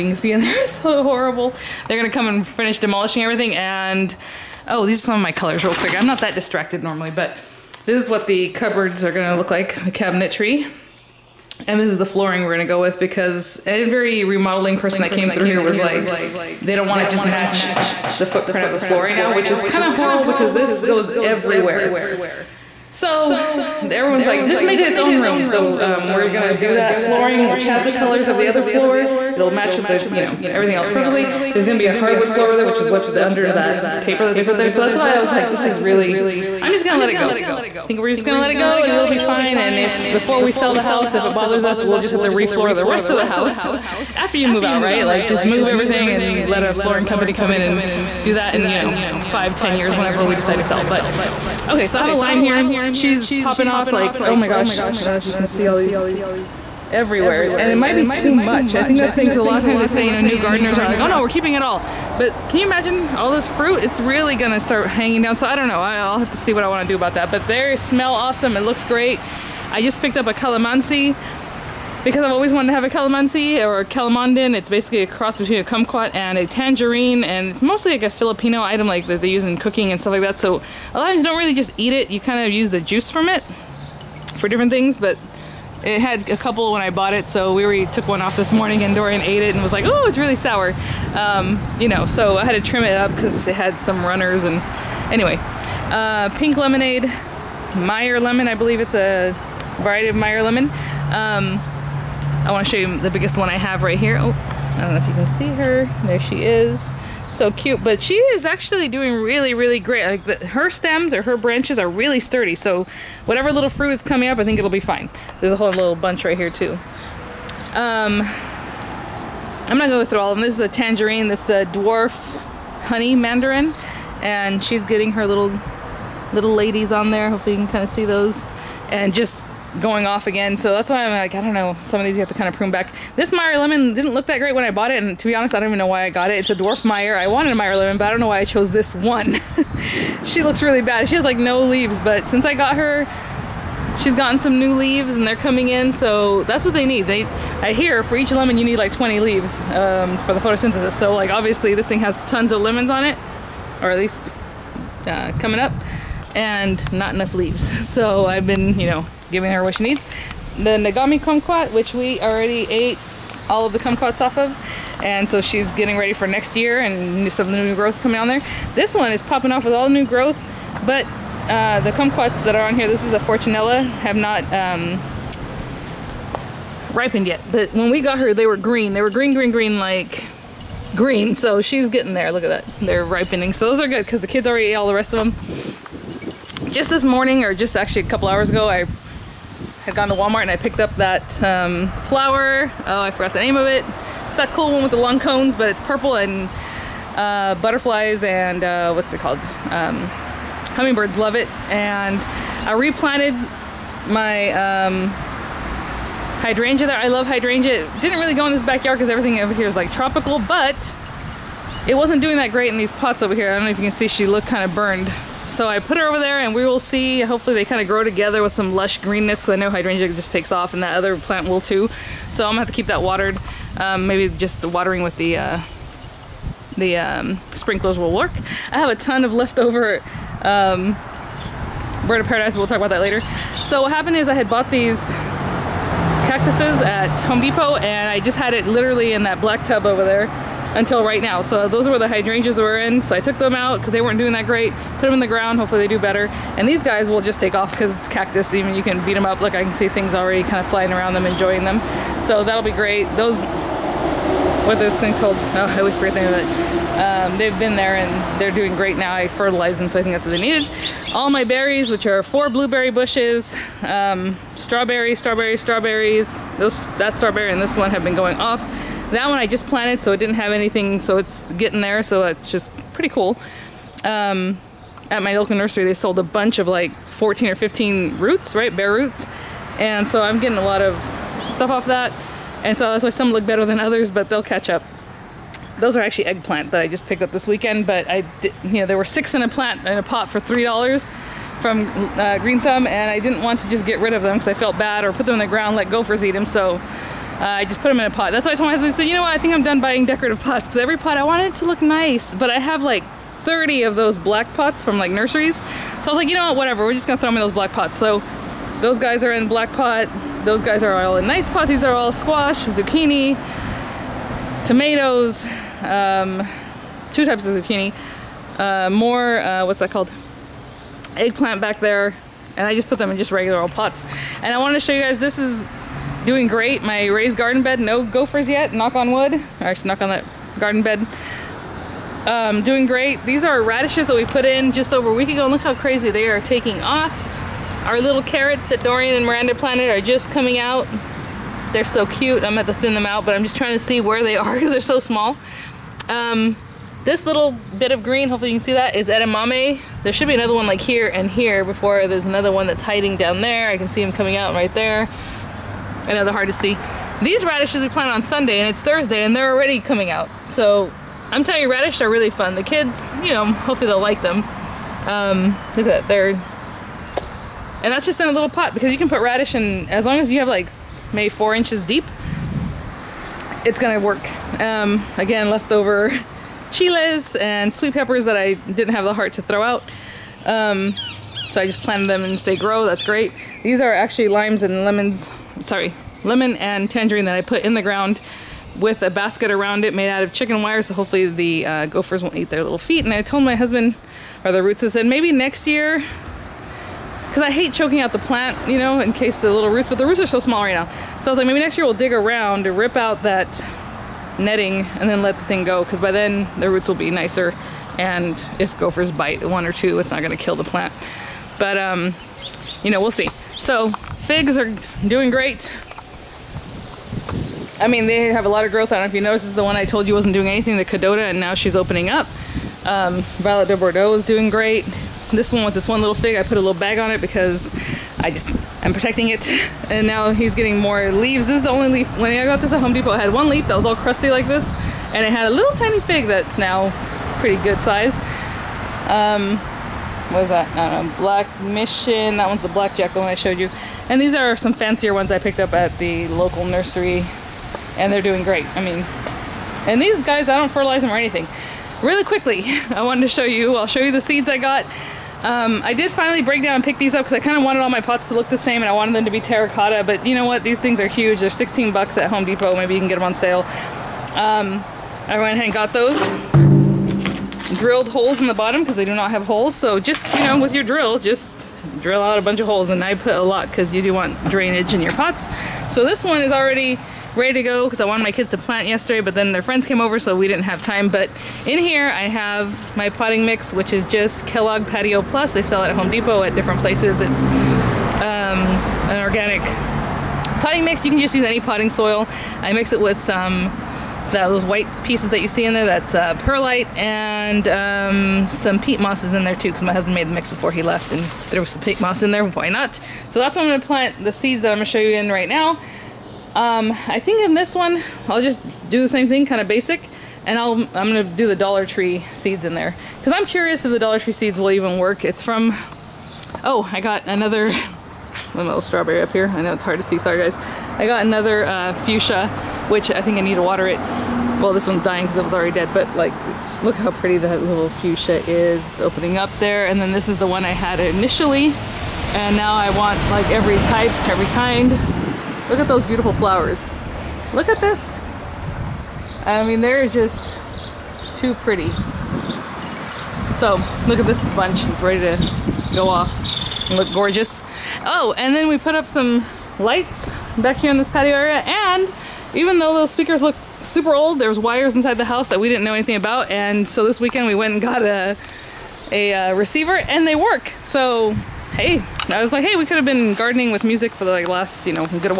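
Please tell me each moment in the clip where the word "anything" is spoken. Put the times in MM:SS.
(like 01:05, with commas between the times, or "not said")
04:30, 07:00, 07:31, 09:15.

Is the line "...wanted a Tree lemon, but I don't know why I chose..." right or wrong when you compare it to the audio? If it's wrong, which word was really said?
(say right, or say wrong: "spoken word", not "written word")
wrong: "Meyer", not "Tree".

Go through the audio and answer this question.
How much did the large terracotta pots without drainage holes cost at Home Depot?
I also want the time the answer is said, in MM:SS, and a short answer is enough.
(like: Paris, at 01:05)
16 dollars, at 07:41.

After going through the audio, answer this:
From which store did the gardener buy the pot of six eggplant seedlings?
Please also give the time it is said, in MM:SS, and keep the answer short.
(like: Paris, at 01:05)
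Green Thumb, at 04:52.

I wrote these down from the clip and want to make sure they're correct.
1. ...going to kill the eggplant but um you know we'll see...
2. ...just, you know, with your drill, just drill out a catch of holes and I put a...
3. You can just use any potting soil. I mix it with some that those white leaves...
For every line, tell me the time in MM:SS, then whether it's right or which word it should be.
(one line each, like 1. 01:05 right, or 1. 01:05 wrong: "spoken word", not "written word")
1. 06:50 wrong: "plant", not "eggplant"
2. 07:49 wrong: "bunch", not "catch"
3. 08:11 wrong: "pieces", not "leaves".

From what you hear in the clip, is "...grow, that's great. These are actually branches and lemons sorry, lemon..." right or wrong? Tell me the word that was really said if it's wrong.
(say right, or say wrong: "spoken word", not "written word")
wrong: "limes", not "branches".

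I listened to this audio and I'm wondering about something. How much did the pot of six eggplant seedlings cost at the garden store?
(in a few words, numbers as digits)
3 dollars.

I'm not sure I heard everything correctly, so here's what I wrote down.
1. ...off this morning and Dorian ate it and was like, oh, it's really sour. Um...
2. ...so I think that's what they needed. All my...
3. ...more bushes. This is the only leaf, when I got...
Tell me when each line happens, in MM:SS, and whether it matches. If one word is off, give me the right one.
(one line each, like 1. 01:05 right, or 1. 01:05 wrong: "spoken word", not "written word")
1. 01:28 right
2. 04:19 right
3. 07:10 wrong: "leaves", not "bushes".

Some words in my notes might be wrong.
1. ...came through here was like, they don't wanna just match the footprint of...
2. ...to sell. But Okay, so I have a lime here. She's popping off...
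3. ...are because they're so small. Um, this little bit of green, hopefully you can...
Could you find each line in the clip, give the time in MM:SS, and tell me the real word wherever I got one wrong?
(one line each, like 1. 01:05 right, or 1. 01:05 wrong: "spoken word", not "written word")
1. 00:15 right
2. 00:50 right
3. 05:44 right.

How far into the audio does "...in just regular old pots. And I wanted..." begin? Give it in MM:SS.
05:23.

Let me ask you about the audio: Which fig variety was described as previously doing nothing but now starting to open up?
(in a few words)
Kadota.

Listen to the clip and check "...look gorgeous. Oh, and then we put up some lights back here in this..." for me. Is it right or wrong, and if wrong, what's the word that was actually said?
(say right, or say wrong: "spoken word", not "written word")
right.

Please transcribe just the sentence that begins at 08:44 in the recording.
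Well, this one's dying because it was already dead, but like, look how pretty that little fuchsia is.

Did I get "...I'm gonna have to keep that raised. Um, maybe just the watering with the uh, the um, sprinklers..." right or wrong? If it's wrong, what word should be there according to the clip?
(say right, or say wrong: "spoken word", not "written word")
wrong: "watered", not "raised".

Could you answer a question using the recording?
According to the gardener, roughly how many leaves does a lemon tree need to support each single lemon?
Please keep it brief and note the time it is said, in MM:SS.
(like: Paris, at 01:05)
20, at 02:28.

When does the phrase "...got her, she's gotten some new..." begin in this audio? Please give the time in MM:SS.
02:22.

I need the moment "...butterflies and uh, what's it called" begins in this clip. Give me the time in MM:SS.
03:17.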